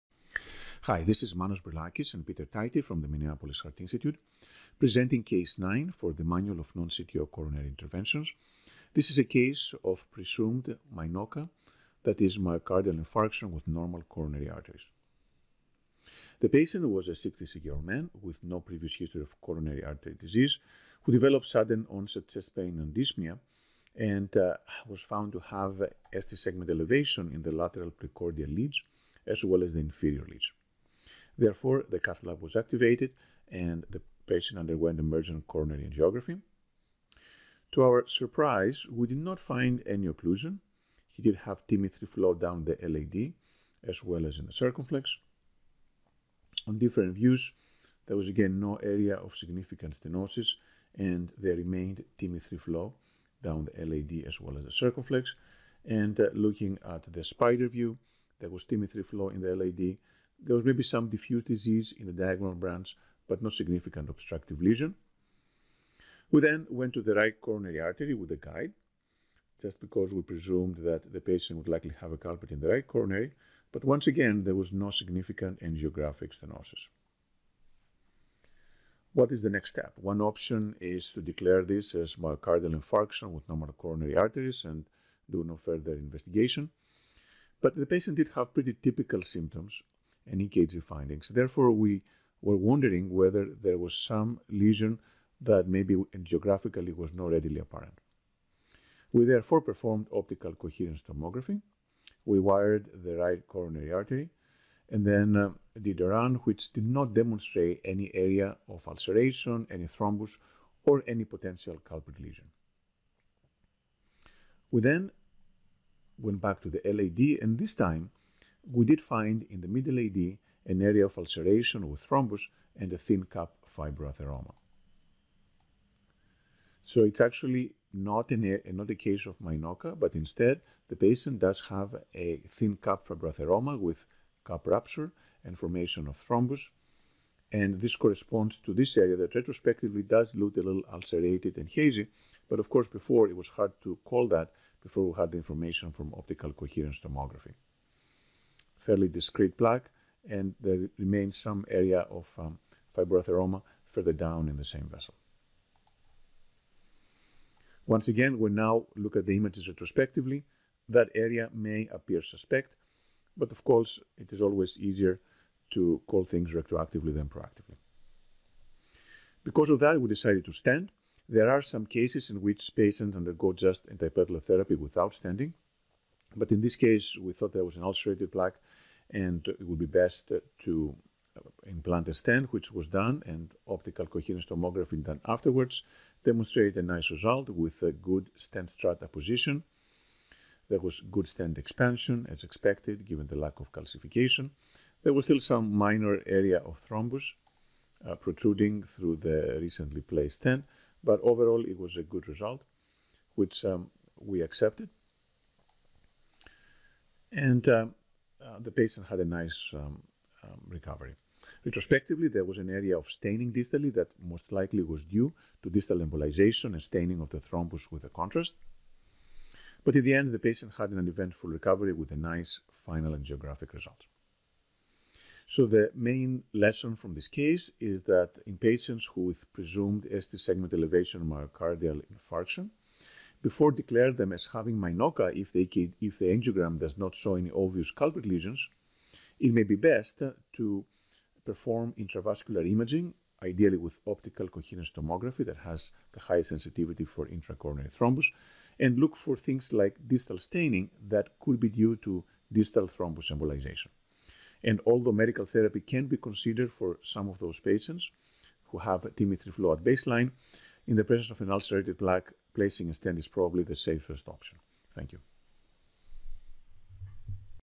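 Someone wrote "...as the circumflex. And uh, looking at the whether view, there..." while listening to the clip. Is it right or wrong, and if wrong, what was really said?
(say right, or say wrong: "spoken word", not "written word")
wrong: "spider", not "whether".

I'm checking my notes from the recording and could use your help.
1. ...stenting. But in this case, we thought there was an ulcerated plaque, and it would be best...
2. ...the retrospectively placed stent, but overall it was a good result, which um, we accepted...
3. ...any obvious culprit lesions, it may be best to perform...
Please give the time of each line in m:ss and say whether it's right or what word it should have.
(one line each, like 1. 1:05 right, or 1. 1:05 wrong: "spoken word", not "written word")
1. 2:55 right
2. 3:19 wrong: "recently", not "retrospectively"
3. 3:57 right.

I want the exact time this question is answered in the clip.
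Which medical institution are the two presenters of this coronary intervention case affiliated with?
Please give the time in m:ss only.
0:03.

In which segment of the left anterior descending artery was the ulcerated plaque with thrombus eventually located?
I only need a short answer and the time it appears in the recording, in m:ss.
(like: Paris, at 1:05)
Mid LAD, at 1:59.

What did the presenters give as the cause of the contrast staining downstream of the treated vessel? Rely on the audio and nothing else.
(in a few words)
Distal embolization.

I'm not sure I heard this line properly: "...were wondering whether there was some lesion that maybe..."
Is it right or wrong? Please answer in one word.
right.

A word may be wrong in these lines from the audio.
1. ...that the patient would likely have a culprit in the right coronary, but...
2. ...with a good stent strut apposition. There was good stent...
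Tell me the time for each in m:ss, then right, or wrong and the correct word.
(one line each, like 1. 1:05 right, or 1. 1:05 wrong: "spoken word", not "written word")
1. 1:10 right
2. 3:07 right.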